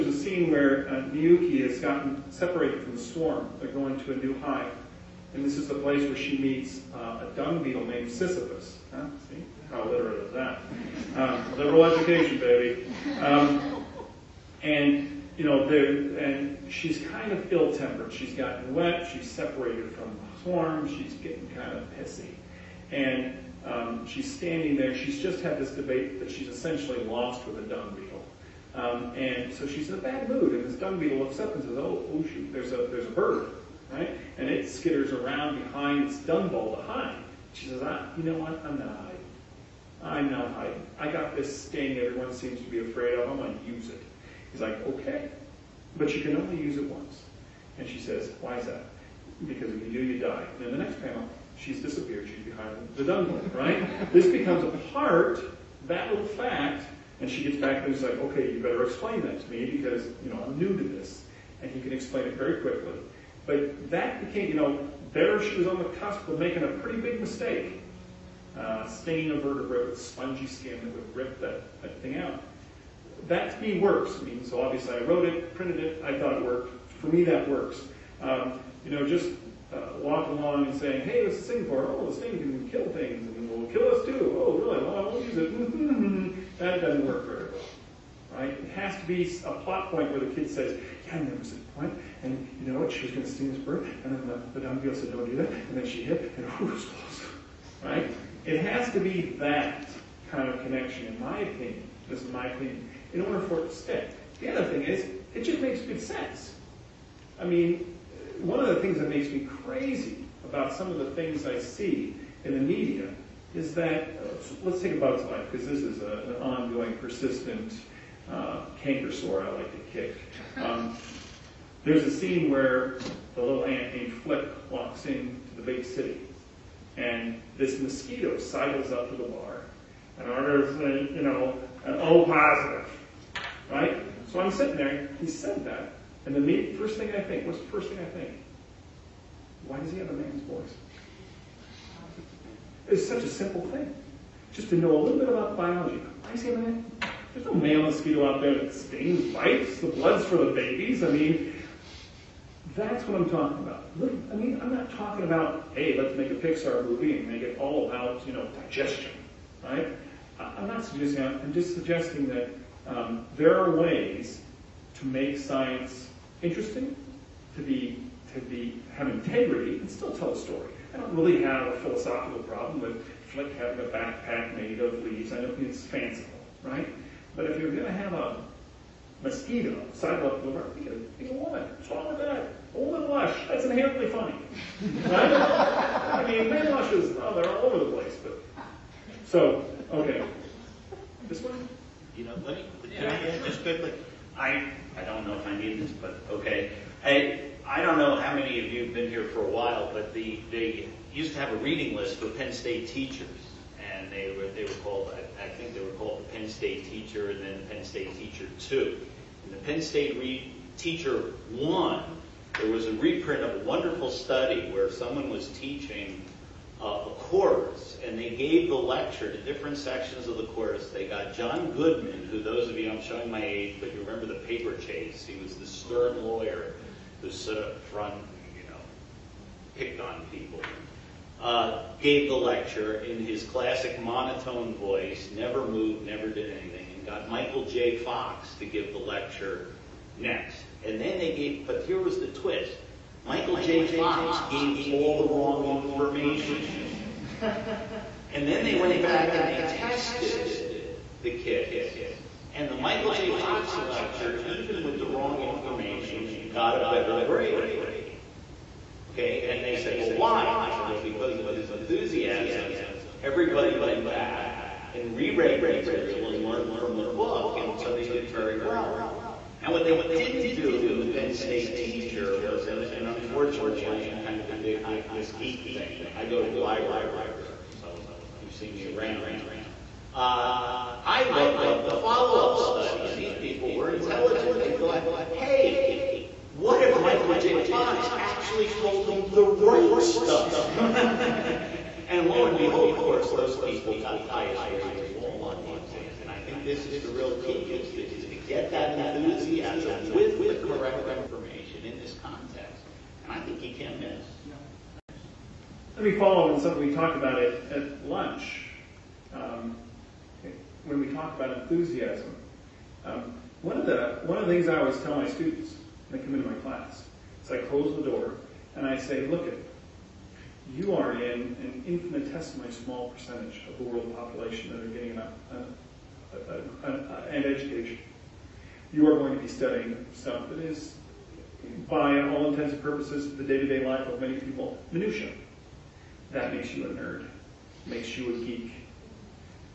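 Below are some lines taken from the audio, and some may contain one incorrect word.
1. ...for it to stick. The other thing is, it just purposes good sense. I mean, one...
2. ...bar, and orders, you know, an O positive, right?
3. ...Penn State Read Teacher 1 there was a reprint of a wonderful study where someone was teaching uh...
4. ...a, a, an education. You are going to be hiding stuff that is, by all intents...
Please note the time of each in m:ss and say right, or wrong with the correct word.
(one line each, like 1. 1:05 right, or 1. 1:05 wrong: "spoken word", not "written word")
1. 1:43 wrong: "makes", not "purposes"
2. 2:09 right
3. 3:29 right
4. 5:26 wrong: "studying", not "hiding".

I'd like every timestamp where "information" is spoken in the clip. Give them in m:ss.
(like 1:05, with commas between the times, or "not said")
4:05, 4:15, 5:01.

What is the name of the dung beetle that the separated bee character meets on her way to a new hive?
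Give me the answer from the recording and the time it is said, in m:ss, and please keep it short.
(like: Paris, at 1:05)
Sisyphus, at 0:08.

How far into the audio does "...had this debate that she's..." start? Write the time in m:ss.
0:25.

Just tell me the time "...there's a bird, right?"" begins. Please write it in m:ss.
0:32.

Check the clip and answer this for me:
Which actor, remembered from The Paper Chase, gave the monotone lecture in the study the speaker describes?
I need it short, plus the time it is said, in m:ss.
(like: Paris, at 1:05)
John Goodman, at 3:41.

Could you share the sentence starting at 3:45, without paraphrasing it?
He was the stern lawyer who stood up front you know, picked on people.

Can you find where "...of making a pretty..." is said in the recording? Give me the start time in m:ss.
1:06.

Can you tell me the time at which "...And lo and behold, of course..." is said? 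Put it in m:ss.
4:52.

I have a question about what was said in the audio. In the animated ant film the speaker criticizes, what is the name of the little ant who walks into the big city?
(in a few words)
Flip.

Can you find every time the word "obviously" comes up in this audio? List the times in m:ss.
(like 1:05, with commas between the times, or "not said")
1:14.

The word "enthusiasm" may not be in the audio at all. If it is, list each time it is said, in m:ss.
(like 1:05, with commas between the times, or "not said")
4:21, 4:58, 5:11.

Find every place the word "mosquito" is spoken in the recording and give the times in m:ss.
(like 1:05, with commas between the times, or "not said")
2:07, 2:27, 2:59.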